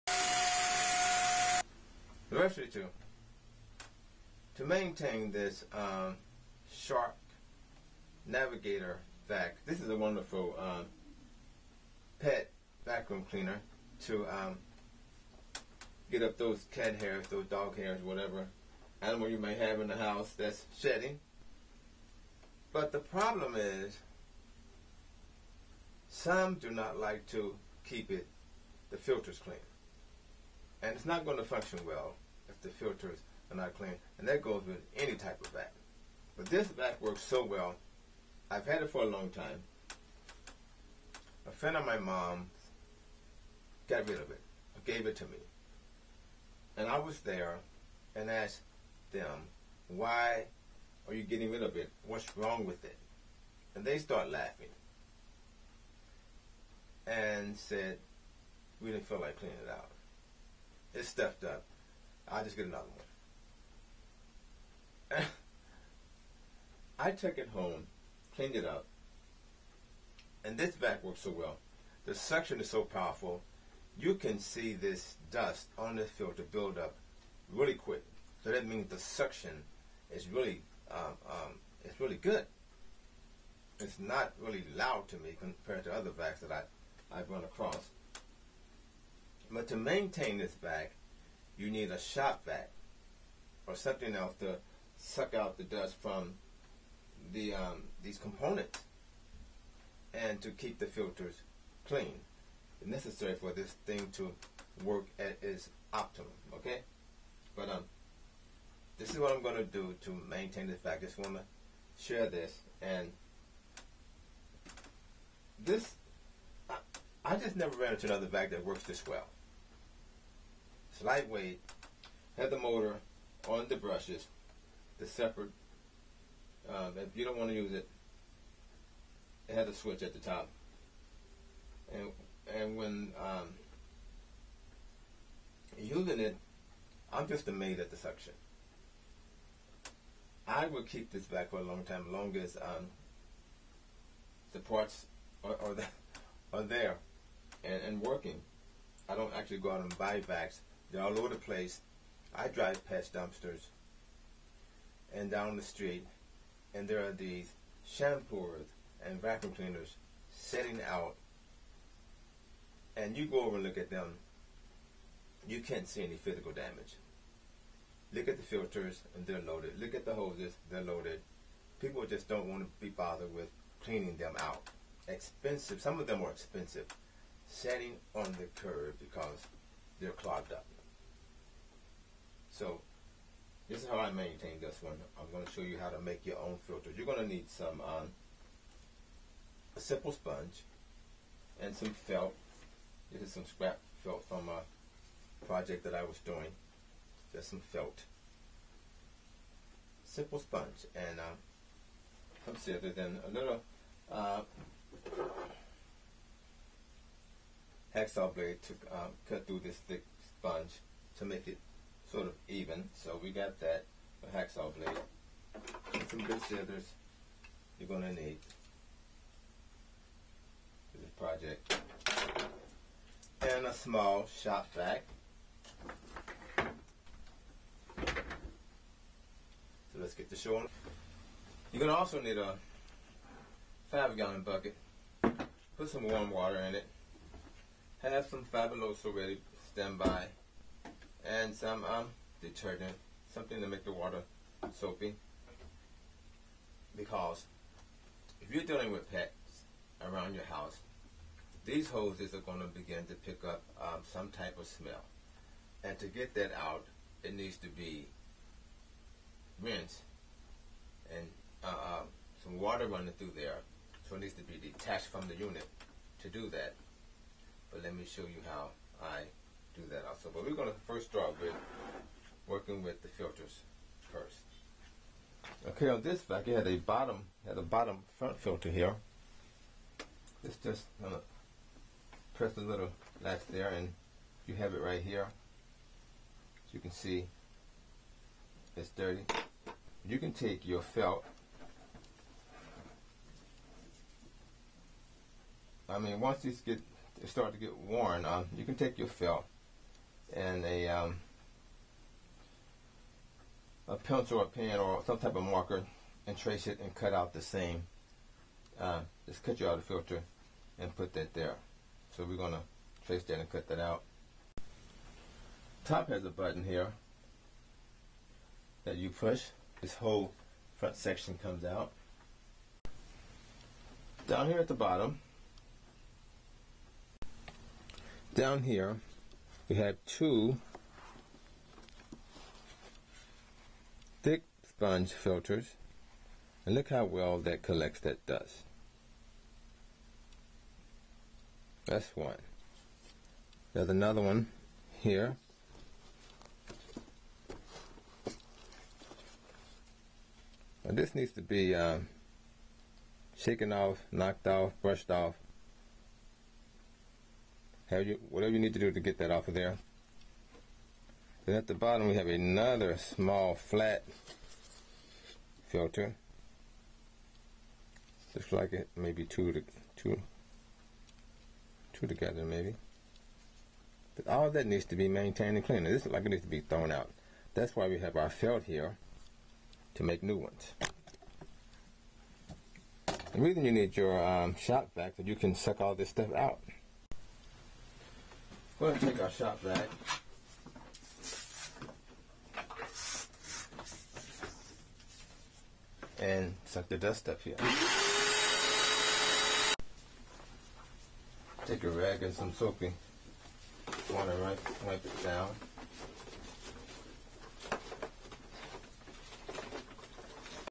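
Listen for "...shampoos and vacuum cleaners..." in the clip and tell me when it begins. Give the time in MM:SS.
02:37.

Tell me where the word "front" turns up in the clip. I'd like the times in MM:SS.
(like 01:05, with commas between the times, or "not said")
04:38, 05:20.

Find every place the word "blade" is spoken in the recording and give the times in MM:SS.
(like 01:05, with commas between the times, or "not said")
03:28, 03:34.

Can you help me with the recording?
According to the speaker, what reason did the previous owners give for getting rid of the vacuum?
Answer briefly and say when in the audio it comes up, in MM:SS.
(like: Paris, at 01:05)
didn't feel like cleaning it, at 00:58.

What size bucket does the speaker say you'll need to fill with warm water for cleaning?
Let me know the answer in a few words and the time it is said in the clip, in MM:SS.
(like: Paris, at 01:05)
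5 gallon, at 03:53.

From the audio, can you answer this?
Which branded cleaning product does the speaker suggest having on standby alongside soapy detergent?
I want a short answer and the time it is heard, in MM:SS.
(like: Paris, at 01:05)
Fabuloso, at 03:58.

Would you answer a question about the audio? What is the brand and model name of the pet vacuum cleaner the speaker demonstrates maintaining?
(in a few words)
Shark Navigator.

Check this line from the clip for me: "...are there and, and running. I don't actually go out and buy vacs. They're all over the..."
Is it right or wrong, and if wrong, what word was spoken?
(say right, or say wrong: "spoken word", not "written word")
wrong: "working", not "running".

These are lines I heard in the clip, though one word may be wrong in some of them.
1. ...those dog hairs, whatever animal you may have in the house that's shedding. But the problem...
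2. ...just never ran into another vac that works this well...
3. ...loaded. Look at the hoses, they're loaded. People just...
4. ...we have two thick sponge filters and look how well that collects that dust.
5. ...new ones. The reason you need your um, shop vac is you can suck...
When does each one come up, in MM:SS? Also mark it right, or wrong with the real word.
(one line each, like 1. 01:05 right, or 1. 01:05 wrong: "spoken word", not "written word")
1. 00:17 right
2. 01:57 right
3. 02:49 right
4. 05:29 right
5. 06:20 right.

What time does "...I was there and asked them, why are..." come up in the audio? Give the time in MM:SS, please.
00:46.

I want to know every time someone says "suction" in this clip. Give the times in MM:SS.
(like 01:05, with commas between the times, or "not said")
01:12, 01:18, 02:17.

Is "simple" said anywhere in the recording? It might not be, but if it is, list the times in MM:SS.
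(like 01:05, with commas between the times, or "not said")
03:09, 03:20.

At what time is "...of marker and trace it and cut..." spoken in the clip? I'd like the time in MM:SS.
05:05.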